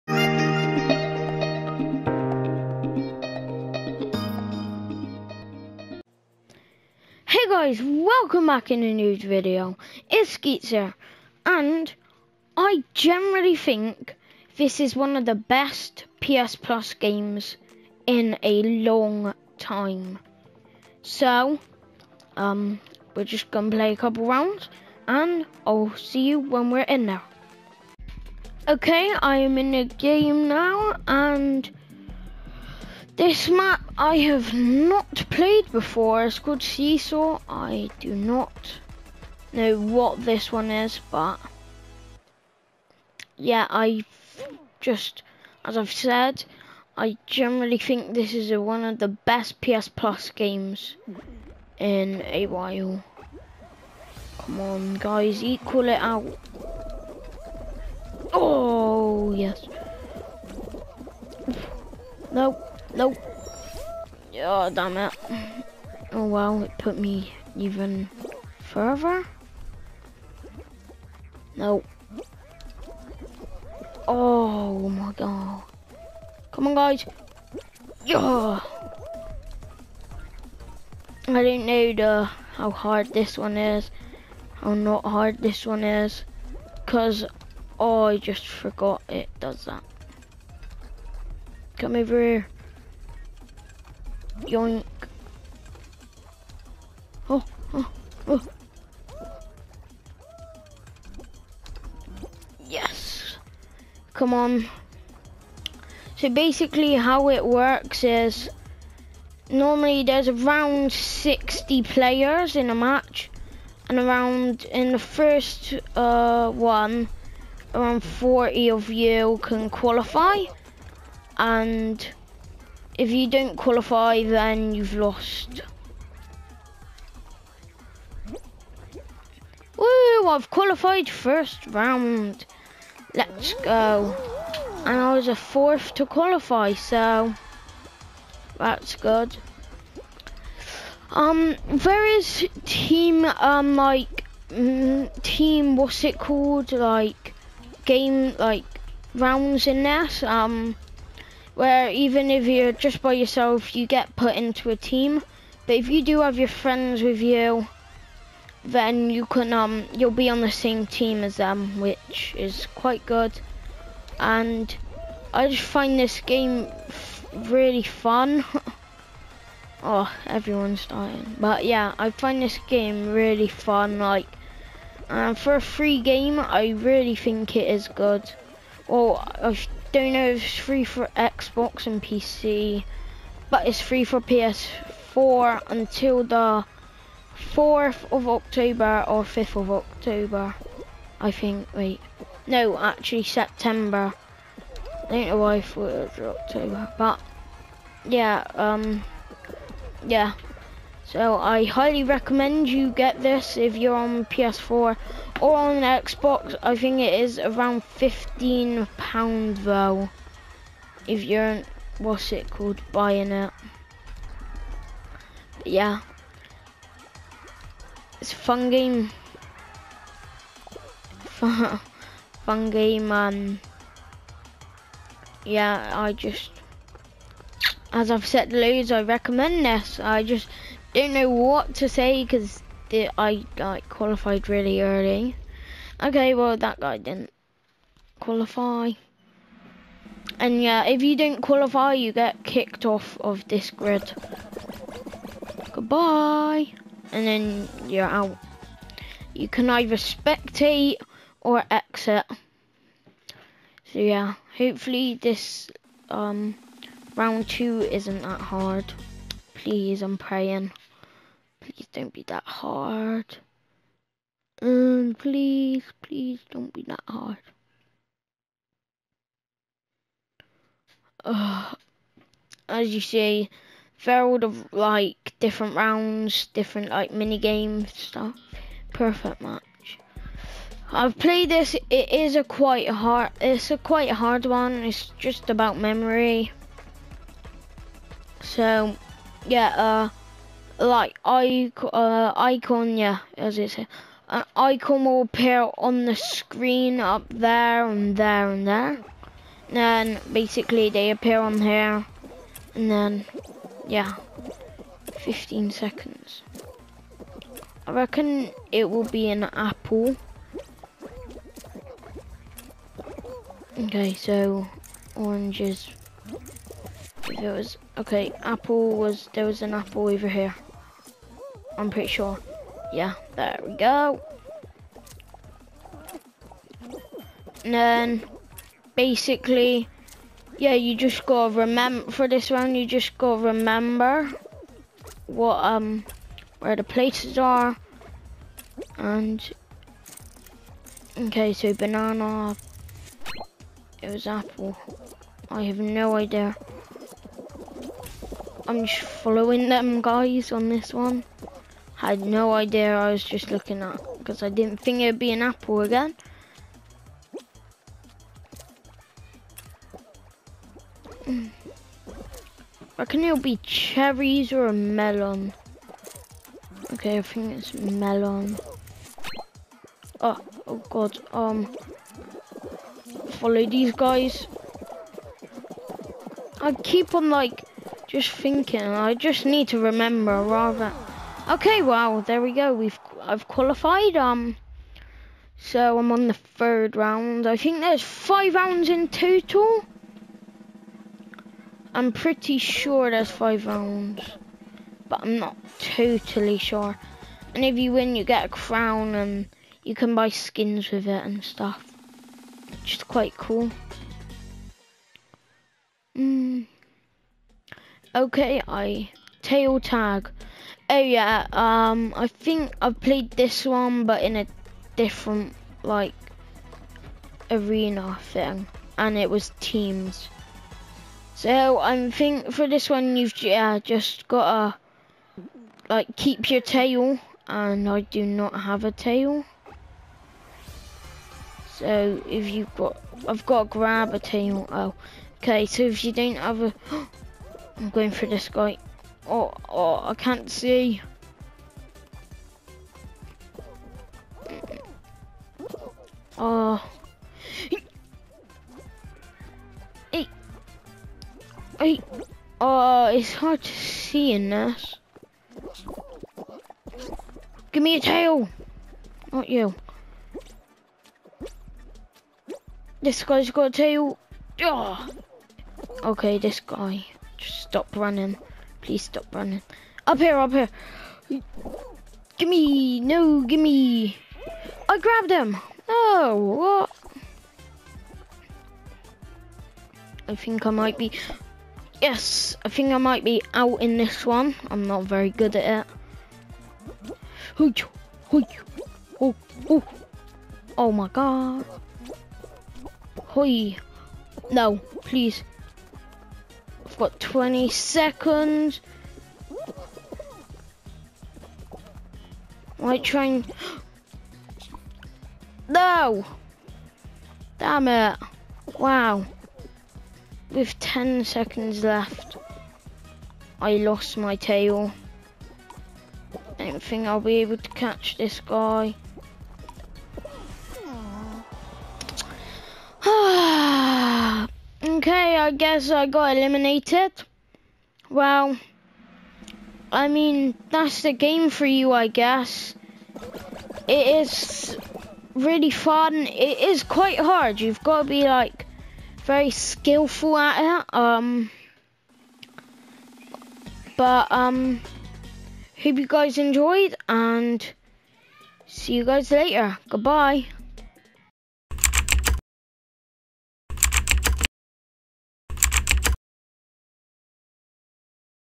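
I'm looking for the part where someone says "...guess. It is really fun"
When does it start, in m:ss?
8:52.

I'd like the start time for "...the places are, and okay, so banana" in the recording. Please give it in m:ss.
5:36.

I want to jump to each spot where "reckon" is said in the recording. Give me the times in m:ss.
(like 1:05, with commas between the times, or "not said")
5:07, 6:02.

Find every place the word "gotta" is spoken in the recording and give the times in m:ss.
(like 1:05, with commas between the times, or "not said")
7:04.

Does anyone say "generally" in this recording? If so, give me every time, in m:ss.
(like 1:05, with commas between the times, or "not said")
0:12, 0:47.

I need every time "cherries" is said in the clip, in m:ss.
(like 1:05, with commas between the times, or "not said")
6:03.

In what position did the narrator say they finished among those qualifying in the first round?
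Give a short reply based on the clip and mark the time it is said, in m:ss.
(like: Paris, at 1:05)
Fourth, at 2:15.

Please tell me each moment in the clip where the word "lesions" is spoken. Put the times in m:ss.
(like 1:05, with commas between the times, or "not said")
not said.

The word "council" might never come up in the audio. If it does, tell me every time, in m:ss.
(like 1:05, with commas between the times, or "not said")
not said.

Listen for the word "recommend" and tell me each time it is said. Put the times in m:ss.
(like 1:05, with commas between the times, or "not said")
3:22, 3:49.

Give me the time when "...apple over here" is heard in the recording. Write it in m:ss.
5:19.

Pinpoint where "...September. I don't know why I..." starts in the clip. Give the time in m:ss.
3:13.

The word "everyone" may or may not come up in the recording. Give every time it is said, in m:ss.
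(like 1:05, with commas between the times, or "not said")
2:50.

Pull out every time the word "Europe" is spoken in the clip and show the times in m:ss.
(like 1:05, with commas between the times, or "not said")
not said.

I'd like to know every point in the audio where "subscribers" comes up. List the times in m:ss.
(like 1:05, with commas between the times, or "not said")
not said.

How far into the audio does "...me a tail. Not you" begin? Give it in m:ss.
7:37.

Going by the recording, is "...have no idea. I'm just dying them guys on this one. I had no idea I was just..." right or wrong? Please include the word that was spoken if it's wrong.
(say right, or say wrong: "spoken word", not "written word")
wrong: "following", not "dying".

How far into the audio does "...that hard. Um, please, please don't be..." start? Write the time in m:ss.
4:22.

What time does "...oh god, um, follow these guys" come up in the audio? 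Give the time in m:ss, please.
6:10.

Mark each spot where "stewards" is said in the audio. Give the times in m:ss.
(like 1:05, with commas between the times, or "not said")
not said.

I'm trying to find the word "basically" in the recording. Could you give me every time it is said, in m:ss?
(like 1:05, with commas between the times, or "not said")
1:46, 5:00, 5:28.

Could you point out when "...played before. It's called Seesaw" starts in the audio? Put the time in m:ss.
0:35.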